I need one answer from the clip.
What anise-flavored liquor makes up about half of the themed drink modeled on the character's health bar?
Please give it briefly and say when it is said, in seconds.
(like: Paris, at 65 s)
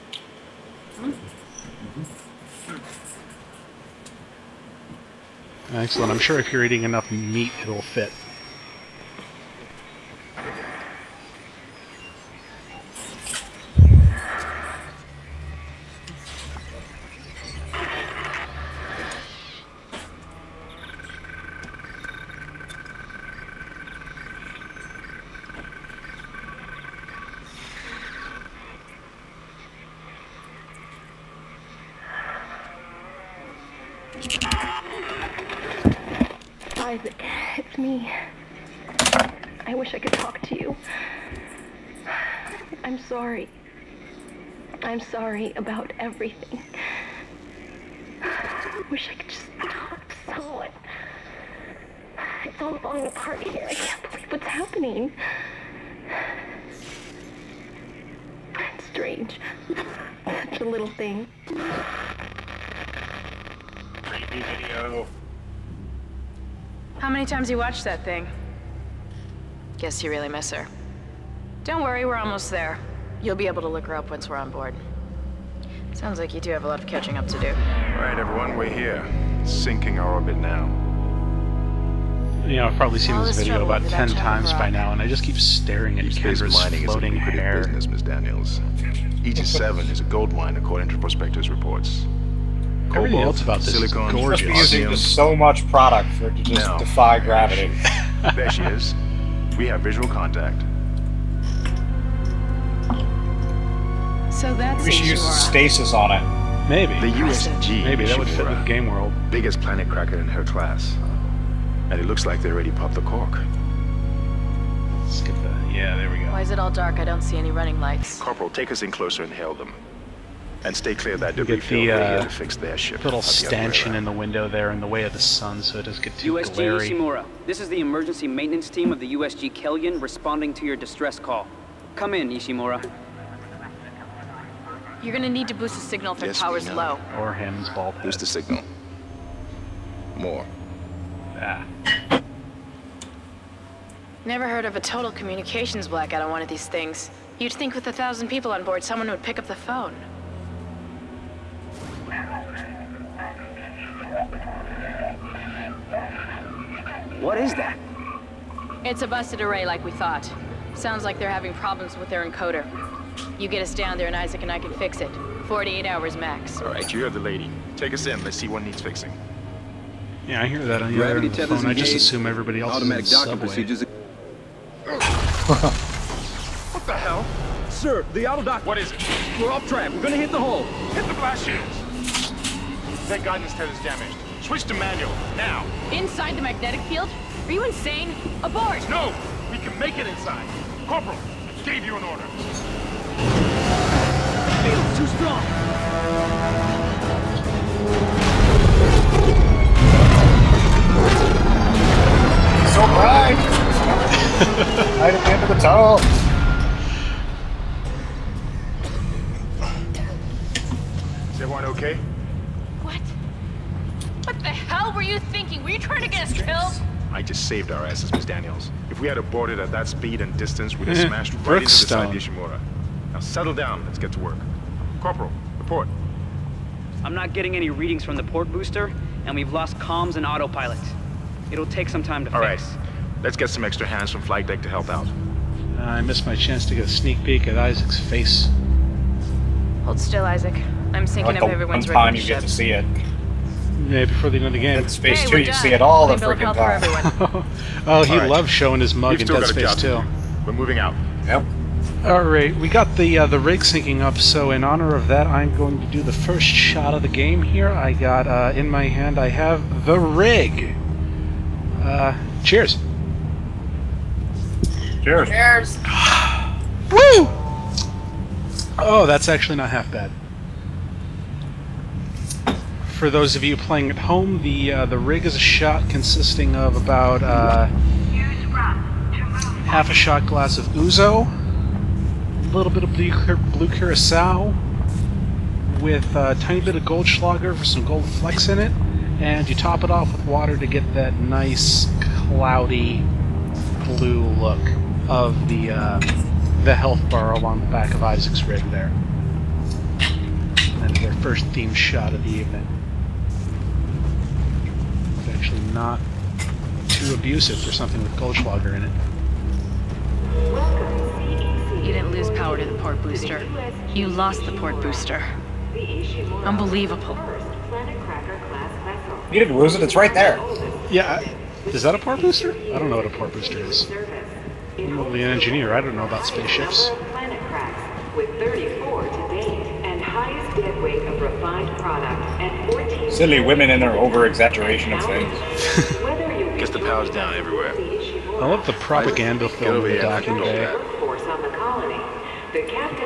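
Ouzo, at 280 s.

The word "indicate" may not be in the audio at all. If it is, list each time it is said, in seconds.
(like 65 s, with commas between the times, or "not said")
not said.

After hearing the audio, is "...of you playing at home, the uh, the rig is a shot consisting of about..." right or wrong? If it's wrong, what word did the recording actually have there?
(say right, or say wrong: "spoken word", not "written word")
right.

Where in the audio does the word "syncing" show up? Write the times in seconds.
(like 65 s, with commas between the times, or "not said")
241 s, 253 s.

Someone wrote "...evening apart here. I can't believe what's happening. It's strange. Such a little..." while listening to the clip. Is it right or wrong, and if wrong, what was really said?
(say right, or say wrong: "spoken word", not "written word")
wrong: "falling", not "evening".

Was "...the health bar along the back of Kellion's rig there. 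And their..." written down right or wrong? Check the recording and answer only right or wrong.
wrong.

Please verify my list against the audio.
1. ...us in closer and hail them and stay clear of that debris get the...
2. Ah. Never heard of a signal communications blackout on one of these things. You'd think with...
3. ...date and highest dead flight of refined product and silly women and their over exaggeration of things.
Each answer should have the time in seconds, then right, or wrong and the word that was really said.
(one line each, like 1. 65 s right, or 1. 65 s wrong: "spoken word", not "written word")
1. 118 s right
2. 141 s wrong: "total", not "signal"
3. 329 s wrong: "weight", not "flight".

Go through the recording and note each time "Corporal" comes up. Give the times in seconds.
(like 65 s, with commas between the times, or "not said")
118 s, 190 s, 225 s.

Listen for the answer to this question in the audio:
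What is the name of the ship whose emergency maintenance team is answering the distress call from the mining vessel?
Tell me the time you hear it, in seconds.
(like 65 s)
129 s.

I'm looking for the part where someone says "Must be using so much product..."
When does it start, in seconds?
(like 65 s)
94 s.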